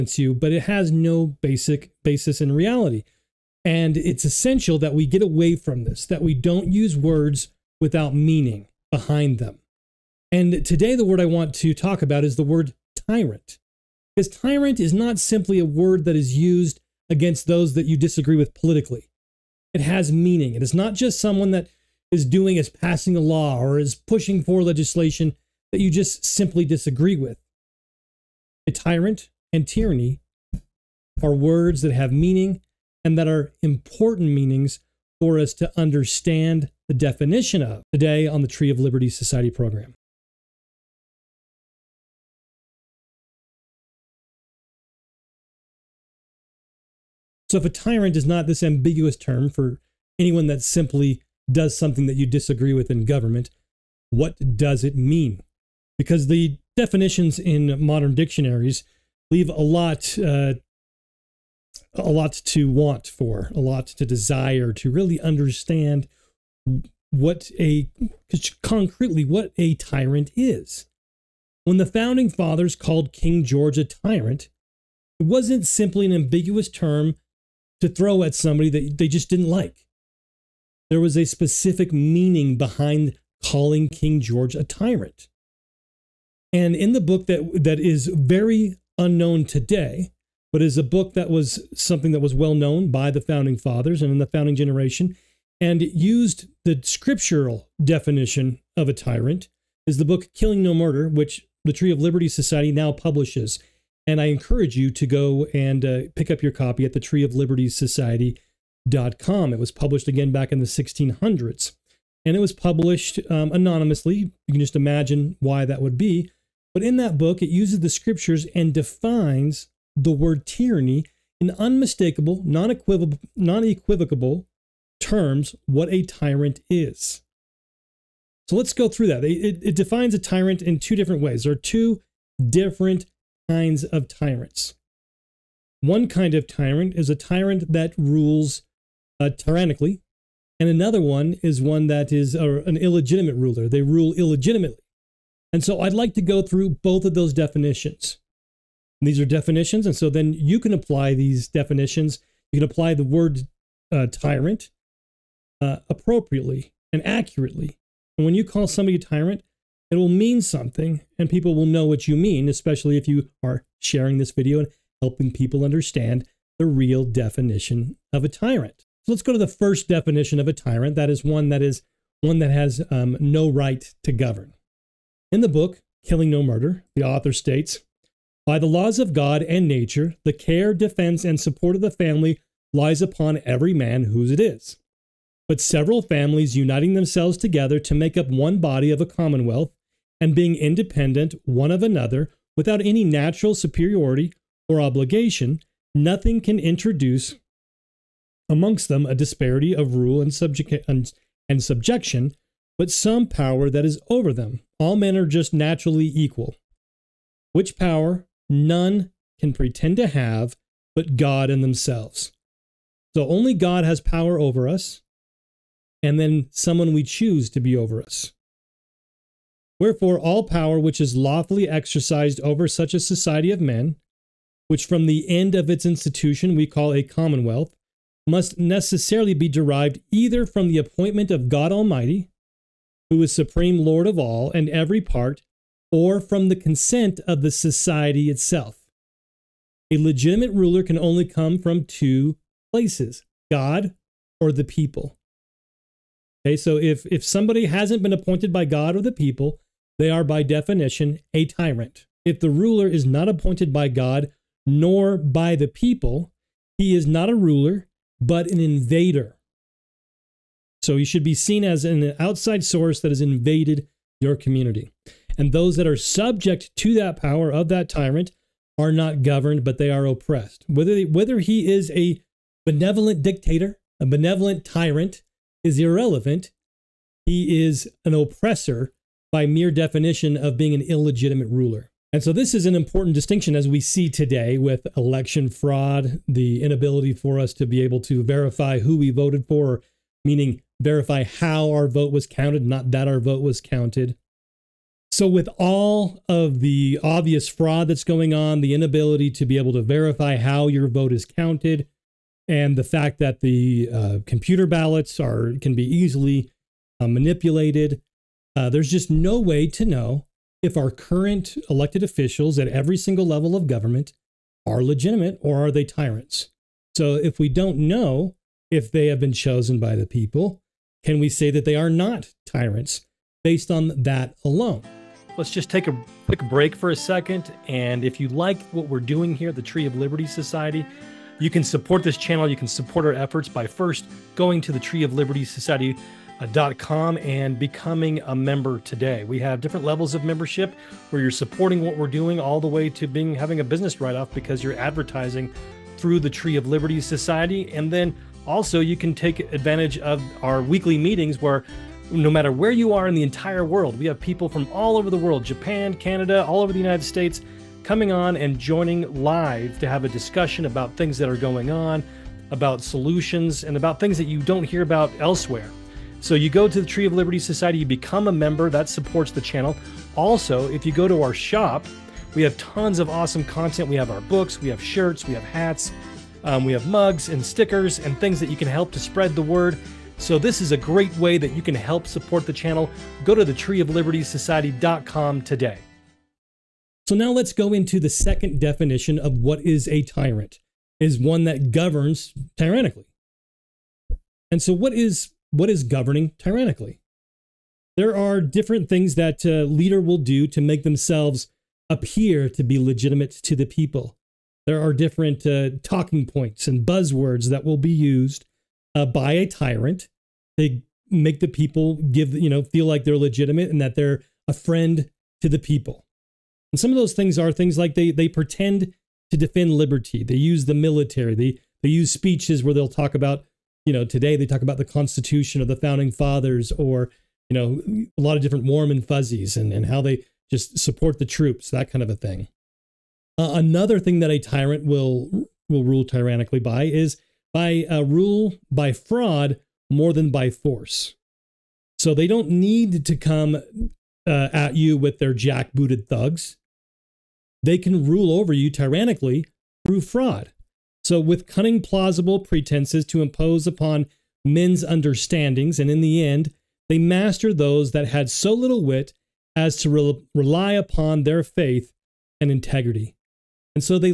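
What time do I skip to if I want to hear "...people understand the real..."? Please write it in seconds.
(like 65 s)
165 s.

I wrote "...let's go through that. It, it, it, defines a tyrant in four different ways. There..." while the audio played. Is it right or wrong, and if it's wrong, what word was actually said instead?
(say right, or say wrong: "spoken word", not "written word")
wrong: "two", not "four".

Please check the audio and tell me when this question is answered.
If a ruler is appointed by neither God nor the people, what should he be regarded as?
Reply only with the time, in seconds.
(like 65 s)
258 s.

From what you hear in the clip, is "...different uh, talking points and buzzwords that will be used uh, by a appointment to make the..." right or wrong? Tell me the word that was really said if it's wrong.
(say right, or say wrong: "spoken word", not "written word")
wrong: "tyrant", not "appointment".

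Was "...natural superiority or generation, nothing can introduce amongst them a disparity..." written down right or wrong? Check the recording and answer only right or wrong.
wrong.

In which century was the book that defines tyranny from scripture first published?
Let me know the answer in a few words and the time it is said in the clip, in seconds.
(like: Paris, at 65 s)
1600s, at 110 s.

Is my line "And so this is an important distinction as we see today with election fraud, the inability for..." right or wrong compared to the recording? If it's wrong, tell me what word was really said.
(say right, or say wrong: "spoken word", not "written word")
right.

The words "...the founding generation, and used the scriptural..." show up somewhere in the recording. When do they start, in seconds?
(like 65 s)
94 s.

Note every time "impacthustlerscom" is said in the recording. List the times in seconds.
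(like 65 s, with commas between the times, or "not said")
not said.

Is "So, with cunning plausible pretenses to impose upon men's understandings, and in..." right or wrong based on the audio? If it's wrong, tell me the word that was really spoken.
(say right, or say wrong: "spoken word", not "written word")
right.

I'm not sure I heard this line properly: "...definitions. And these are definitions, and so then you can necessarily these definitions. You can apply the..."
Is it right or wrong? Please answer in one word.
wrong.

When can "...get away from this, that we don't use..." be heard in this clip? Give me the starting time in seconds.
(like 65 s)
5 s.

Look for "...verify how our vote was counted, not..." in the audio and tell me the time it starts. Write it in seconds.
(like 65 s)
290 s.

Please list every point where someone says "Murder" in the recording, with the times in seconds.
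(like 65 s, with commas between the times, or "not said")
100 s, 176 s.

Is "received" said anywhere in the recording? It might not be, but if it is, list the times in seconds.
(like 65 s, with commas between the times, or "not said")
not said.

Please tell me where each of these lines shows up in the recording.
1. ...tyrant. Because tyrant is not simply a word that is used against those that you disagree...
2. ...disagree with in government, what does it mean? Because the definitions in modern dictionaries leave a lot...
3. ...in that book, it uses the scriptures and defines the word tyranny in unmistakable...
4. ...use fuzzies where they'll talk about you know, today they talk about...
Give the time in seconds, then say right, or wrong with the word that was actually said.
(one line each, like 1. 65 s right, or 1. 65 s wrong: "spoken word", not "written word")
1. 13 s right
2. 52 s right
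3. 116 s right
4. 421 s wrong: "speeches", not "fuzzies".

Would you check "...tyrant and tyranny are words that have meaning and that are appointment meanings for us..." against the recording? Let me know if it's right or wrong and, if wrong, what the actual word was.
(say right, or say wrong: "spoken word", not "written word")
wrong: "important", not "appointment".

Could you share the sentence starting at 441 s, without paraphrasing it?
So they don't need to come uh, at you with their jackbooted thugs.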